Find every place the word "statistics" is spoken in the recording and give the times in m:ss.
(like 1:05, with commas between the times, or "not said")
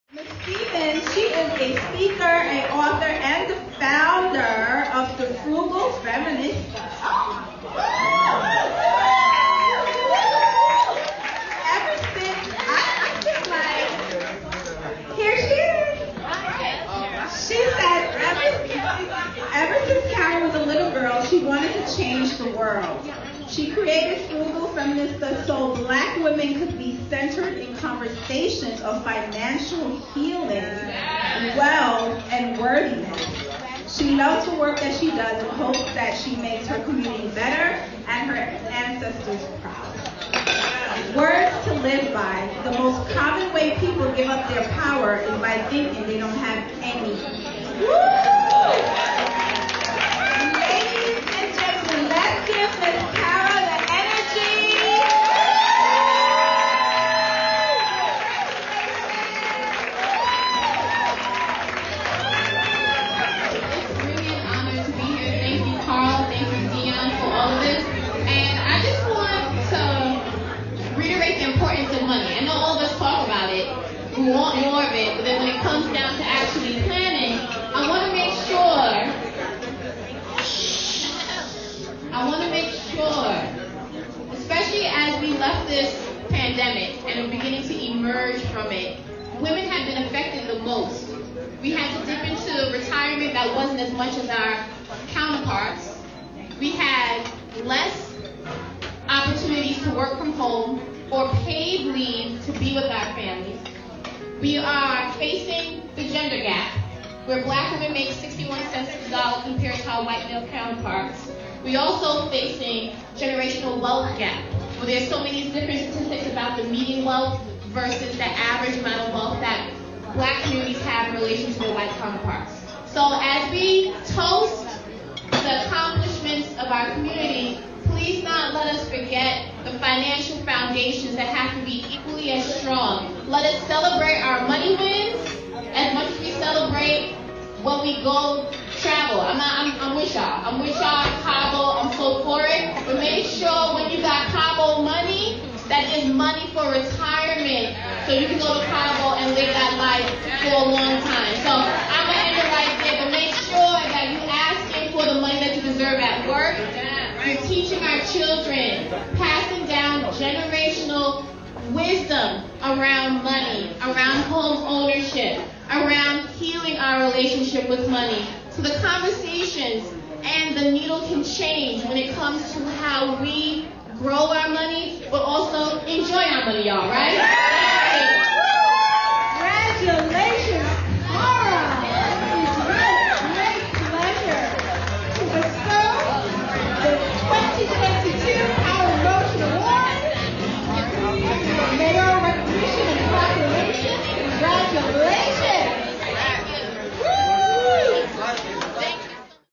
1:55.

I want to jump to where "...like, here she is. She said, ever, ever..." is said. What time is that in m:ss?
0:14.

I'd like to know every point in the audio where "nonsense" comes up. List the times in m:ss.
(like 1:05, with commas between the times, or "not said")
not said.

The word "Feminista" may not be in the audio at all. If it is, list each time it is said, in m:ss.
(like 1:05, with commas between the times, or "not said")
0:05, 0:24.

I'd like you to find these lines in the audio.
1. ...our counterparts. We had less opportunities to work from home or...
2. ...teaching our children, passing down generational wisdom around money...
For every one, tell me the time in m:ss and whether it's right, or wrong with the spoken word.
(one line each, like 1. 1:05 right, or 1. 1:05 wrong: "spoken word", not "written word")
1. 1:34 right
2. 2:37 right.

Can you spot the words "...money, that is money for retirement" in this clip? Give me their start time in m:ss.
2:24.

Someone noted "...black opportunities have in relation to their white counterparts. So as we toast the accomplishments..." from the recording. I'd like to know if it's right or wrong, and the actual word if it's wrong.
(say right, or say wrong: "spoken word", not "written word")
wrong: "communities", not "opportunities".